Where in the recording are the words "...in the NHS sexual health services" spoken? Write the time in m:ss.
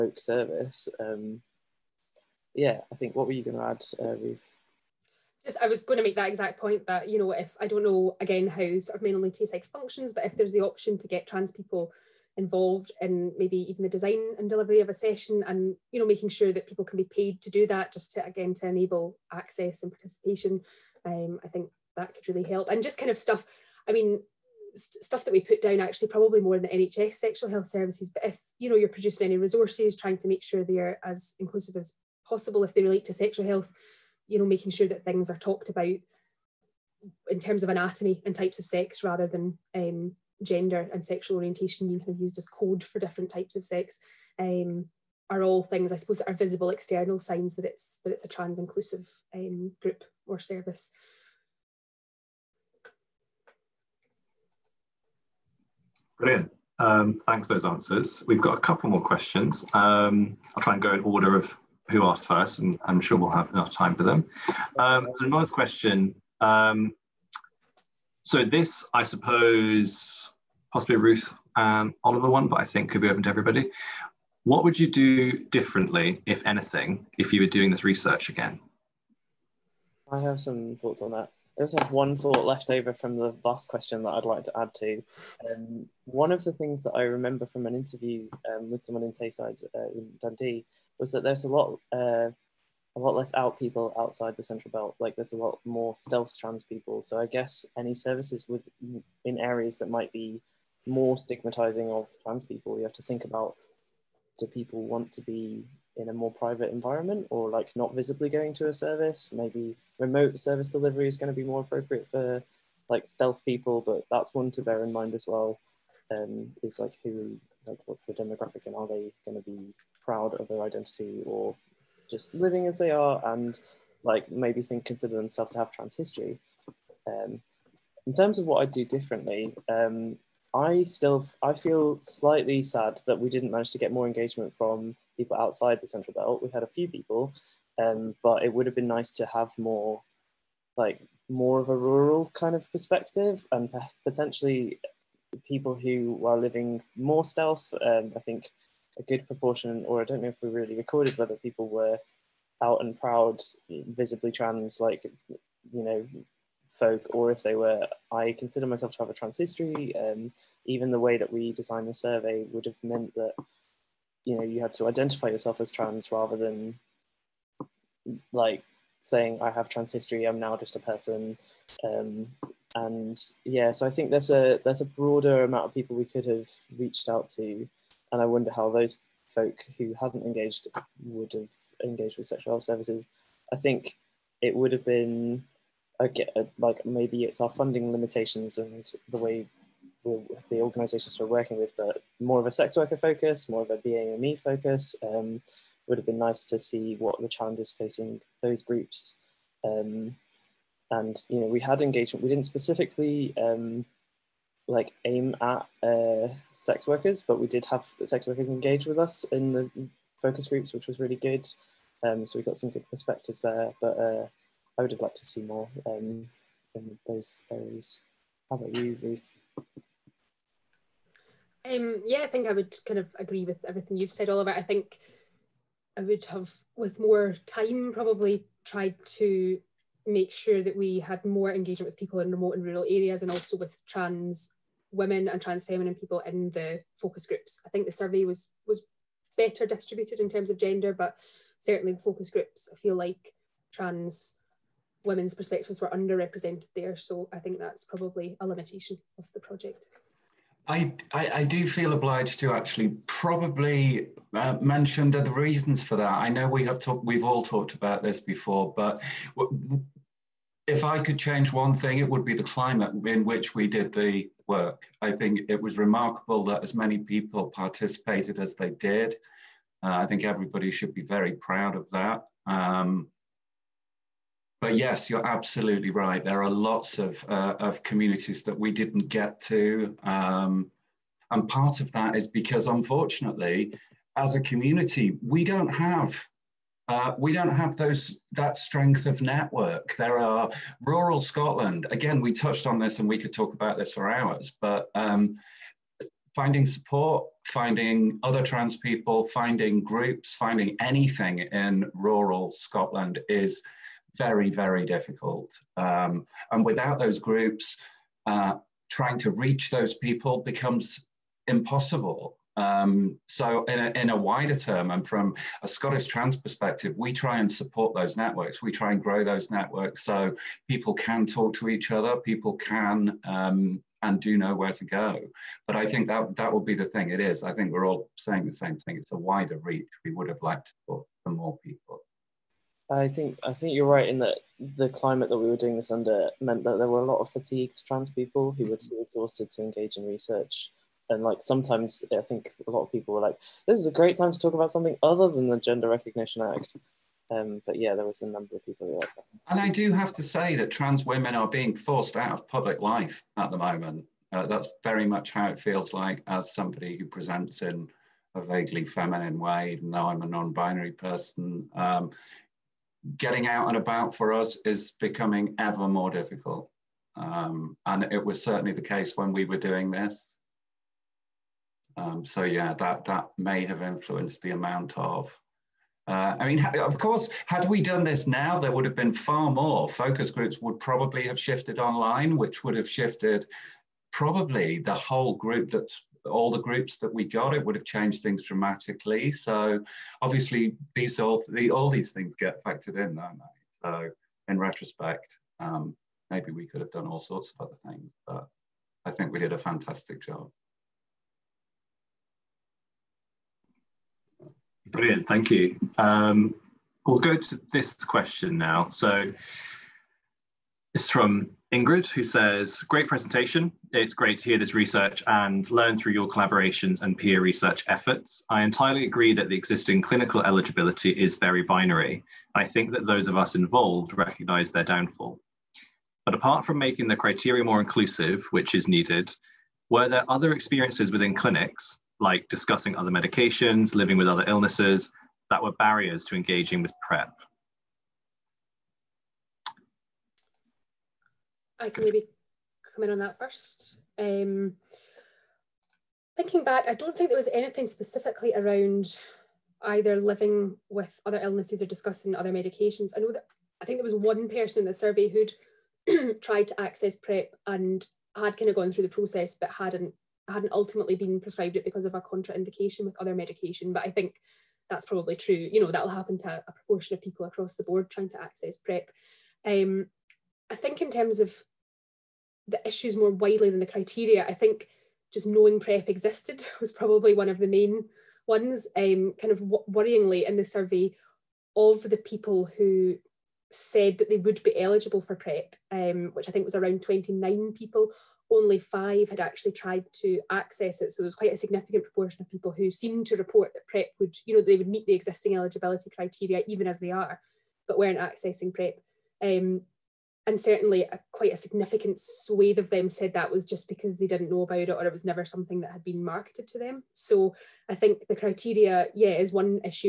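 0:26.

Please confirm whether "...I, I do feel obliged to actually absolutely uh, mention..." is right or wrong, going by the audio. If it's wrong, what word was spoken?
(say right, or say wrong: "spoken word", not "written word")
wrong: "probably", not "absolutely".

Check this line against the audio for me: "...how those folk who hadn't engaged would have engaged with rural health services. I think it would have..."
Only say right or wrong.
wrong.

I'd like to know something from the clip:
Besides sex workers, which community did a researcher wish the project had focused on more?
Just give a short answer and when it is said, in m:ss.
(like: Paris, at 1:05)
BAME, at 3:13.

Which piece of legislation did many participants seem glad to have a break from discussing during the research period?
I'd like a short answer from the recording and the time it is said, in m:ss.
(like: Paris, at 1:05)
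Gender Recognition Act, at 5:45.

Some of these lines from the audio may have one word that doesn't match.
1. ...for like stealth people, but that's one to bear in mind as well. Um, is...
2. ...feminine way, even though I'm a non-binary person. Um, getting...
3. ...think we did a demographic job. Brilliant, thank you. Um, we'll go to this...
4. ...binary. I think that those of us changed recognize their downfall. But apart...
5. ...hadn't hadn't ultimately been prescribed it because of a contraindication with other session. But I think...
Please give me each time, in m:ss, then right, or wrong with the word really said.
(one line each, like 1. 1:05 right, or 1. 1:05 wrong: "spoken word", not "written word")
1. 1:52 right
2. 5:58 right
3. 6:39 wrong: "fantastic", not "demographic"
4. 7:01 wrong: "involved", not "changed"
5. 7:39 wrong: "medication", not "session".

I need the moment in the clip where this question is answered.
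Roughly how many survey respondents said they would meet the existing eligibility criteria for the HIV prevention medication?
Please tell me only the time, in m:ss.
8:07.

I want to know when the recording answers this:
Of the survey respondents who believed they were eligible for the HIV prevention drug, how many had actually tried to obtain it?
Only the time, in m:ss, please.
8:08.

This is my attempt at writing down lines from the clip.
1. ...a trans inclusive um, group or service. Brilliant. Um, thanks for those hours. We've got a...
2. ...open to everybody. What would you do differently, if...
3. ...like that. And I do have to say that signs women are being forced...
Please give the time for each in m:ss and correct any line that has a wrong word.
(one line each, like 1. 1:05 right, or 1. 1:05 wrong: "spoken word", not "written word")
1. 0:48 wrong: "answers", not "hours"
2. 1:13 right
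3. 5:49 wrong: "trans", not "signs".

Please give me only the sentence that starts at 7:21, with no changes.
I can maybe come in on that first.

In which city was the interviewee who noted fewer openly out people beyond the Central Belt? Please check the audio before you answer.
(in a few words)
Dundee.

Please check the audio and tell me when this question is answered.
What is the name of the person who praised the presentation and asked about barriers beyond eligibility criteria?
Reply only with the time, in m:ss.
6:51.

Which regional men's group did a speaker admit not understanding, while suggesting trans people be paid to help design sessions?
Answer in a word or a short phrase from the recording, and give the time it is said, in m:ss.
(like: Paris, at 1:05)
Men Only Tayside, at 0:09.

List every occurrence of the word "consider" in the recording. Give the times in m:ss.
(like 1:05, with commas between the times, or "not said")
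2:04, 2:38.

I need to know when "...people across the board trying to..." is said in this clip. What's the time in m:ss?
7:47.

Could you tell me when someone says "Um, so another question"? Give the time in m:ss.
1:04.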